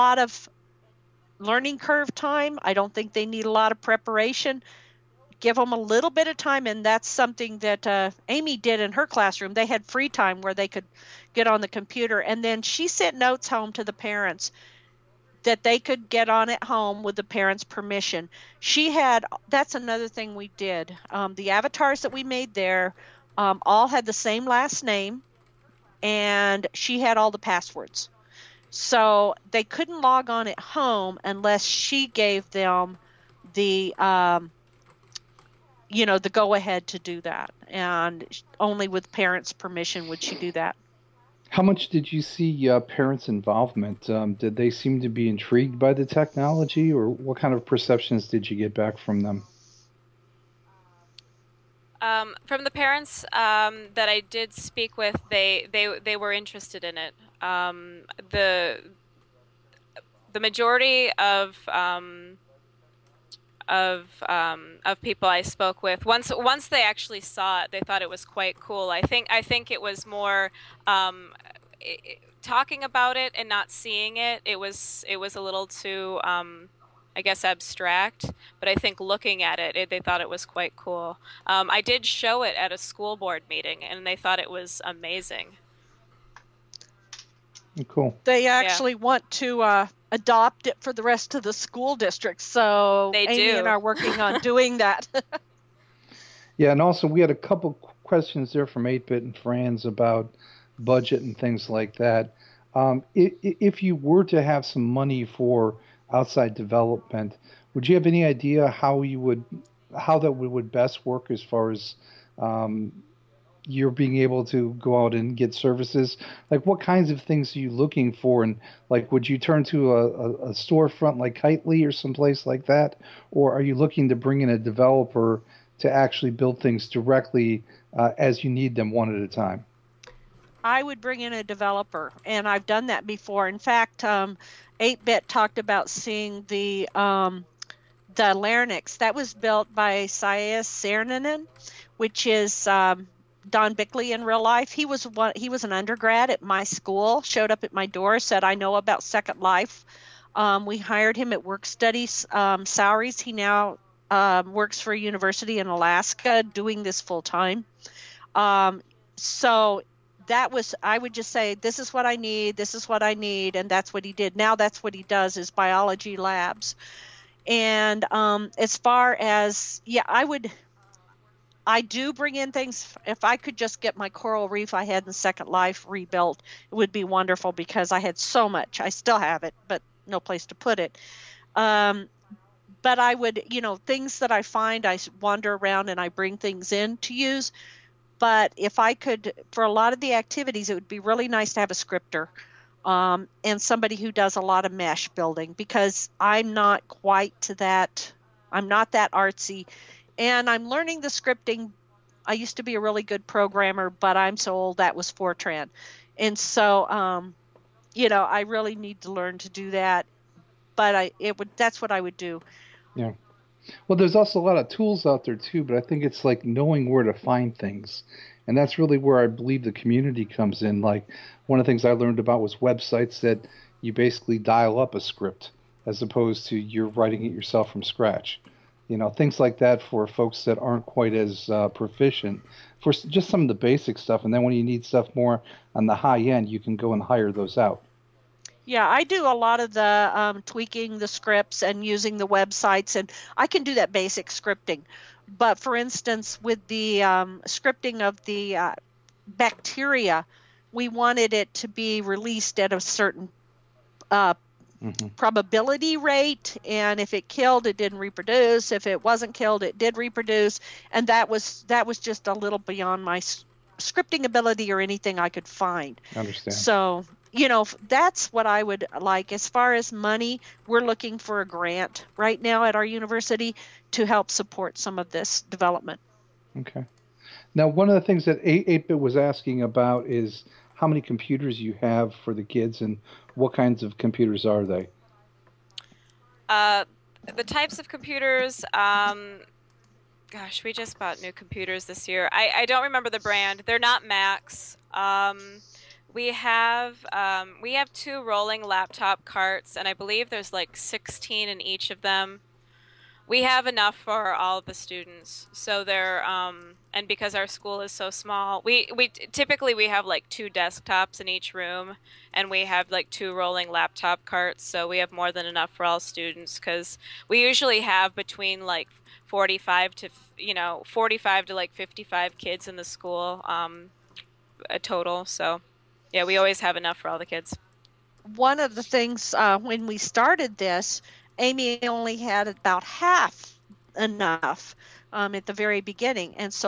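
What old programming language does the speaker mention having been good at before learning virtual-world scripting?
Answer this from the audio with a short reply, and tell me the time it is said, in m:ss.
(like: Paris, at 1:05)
Fortran, at 3:25.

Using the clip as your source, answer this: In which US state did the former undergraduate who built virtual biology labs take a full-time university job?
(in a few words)
Alaska.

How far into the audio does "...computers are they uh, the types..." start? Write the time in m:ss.
4:43.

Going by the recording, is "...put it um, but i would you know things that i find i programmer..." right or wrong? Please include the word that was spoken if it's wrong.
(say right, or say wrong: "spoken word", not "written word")
wrong: "wander", not "programmer".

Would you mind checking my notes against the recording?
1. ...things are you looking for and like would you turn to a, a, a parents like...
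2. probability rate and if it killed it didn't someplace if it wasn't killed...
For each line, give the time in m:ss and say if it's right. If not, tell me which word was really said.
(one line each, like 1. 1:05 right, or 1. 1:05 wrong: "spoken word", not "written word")
1. 1:57 wrong: "storefront", not "parents"
2. 4:15 wrong: "reproduce", not "someplace".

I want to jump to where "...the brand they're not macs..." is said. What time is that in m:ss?
4:53.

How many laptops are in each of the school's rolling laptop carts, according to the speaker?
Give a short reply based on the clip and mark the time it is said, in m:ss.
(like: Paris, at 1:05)
16, at 5:00.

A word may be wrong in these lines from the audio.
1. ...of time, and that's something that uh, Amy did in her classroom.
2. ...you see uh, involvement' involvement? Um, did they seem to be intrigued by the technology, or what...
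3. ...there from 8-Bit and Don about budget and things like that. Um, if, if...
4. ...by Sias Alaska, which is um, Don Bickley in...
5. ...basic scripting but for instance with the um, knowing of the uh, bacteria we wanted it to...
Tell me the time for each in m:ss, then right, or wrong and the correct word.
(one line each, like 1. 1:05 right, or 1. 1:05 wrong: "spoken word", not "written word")
1. 0:06 right
2. 0:42 wrong: "parents", not "involvement"
3. 1:38 wrong: "Franz", not "Don"
4. 2:19 wrong: "Sarninen", not "Alaska"
5. 4:03 wrong: "scripting", not "knowing".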